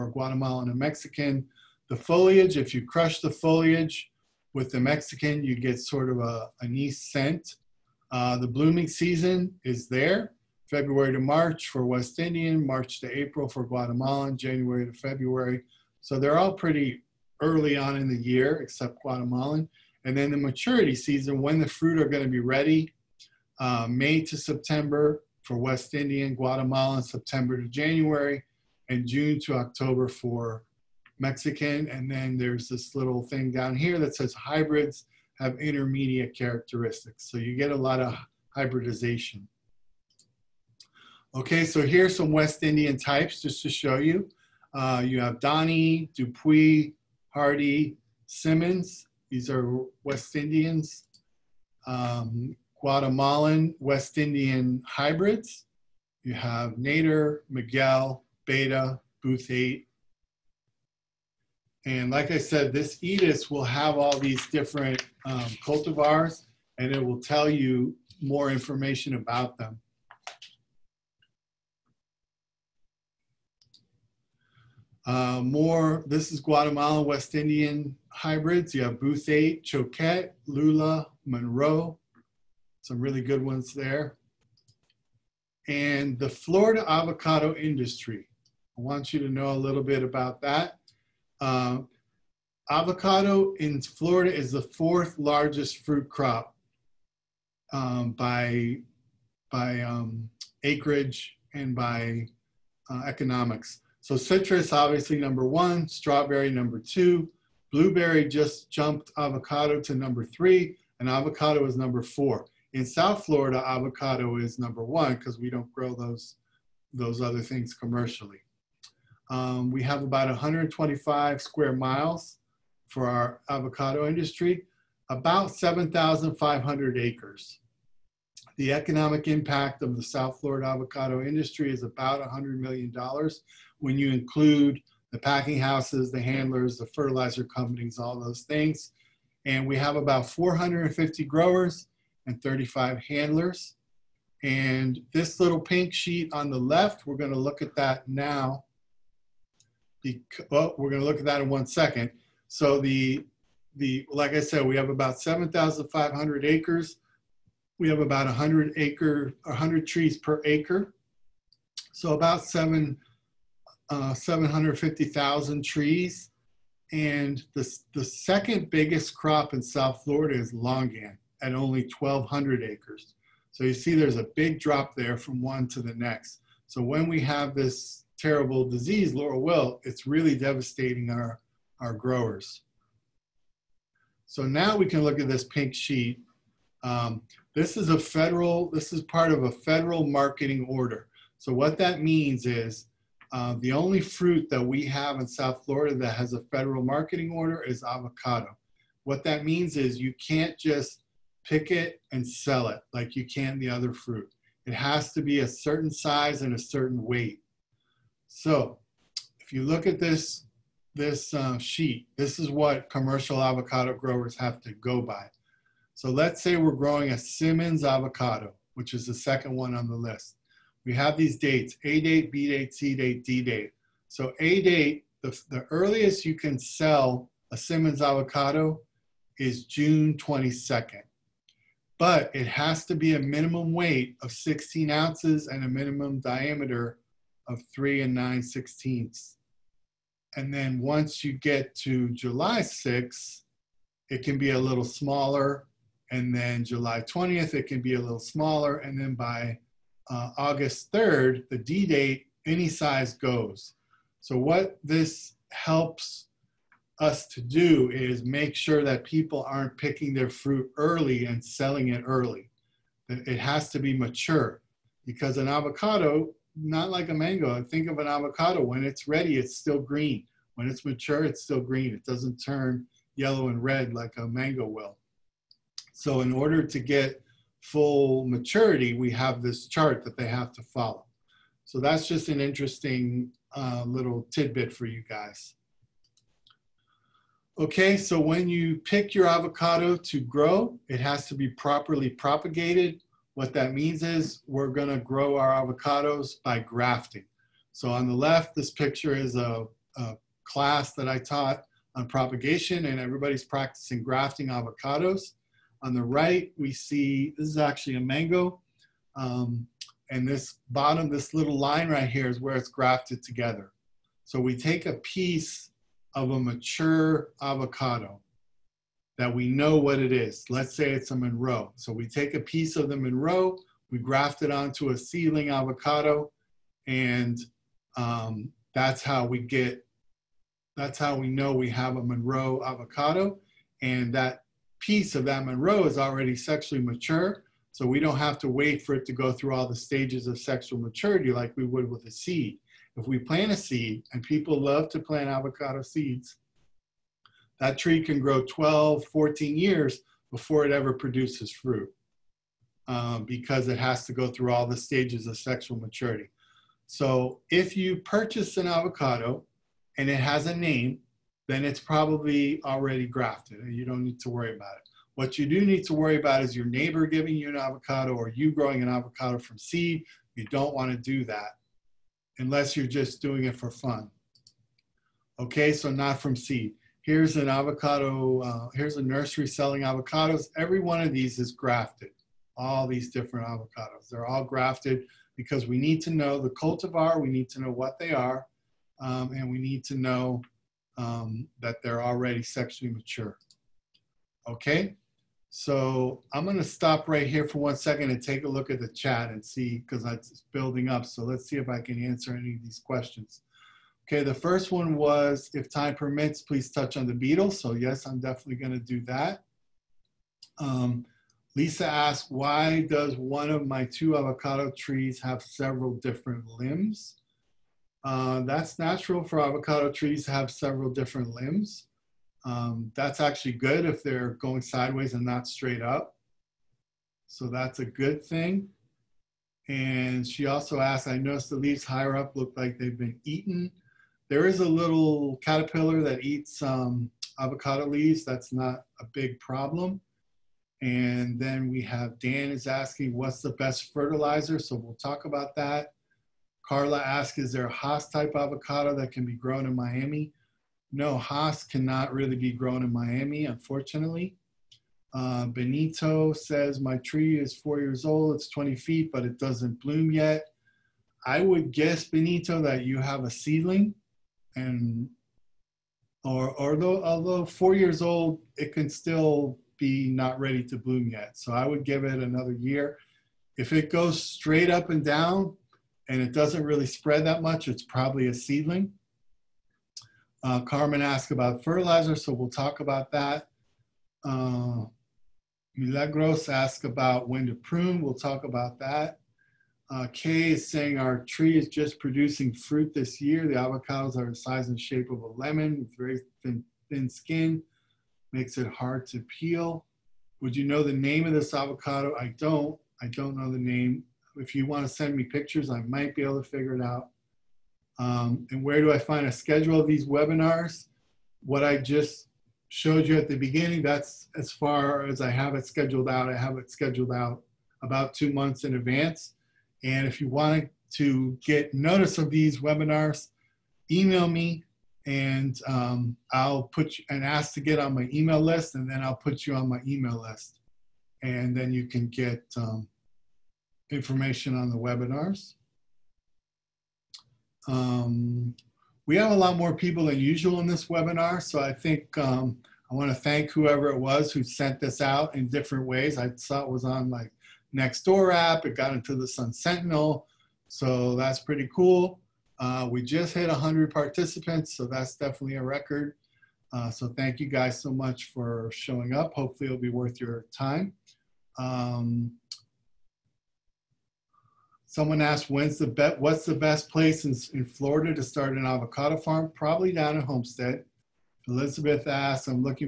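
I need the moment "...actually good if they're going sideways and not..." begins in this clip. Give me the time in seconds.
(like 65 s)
423 s.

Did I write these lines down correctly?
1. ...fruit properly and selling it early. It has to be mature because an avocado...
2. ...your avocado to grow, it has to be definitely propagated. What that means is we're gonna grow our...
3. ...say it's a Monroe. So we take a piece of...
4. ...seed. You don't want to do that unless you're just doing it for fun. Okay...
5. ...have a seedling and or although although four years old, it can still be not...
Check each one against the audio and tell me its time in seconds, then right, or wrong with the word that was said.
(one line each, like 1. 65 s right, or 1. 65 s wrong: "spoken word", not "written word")
1. 260 s wrong: "early", not "properly"
2. 289 s wrong: "properly", not "definitely"
3. 320 s right
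4. 369 s right
5. 462 s right.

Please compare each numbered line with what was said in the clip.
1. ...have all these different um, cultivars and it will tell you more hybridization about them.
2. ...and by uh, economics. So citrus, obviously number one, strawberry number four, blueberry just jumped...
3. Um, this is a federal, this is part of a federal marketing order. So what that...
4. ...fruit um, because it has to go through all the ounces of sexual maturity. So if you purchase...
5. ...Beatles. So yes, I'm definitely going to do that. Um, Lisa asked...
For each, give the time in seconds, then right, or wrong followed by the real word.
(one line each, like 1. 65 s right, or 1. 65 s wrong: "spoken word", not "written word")
1. 63 s wrong: "information", not "hybridization"
2. 101 s wrong: "two", not "four"
3. 186 s right
4. 351 s wrong: "stages", not "ounces"
5. 407 s right.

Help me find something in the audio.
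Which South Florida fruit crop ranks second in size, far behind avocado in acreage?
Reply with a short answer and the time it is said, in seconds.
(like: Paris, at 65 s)
Longan, at 170 s.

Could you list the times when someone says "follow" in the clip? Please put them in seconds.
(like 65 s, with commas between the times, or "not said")
280 s.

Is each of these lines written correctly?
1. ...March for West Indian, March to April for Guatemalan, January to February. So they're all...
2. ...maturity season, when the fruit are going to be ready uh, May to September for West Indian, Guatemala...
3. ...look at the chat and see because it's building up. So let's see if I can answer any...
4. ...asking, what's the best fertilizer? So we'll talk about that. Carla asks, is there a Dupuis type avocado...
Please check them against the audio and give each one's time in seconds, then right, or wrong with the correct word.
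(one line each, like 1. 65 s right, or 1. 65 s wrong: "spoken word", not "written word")
1. 11 s right
2. 20 s right
3. 398 s right
4. 442 s wrong: "Hass", not "Dupuis".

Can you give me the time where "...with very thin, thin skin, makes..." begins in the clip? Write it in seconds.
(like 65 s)
495 s.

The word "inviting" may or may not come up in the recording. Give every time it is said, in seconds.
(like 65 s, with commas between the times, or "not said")
not said.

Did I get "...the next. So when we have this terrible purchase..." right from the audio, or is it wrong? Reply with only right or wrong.
wrong.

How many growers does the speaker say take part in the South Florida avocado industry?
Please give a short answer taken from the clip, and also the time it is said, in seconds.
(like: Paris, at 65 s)
450, at 140 s.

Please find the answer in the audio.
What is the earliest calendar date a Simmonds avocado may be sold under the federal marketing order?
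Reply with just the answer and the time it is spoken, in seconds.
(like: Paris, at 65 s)
June 22nd, at 229 s.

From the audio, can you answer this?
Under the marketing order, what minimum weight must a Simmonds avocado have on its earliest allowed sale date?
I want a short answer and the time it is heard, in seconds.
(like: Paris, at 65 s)
16 ounces, at 234 s.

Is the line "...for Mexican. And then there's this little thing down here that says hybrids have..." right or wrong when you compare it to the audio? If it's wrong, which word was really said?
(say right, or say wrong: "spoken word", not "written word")
right.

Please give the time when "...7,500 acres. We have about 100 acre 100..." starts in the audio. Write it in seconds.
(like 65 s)
155 s.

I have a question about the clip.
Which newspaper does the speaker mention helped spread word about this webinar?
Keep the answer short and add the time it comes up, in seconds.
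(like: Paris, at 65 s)
Sun Sentinel, at 549 s.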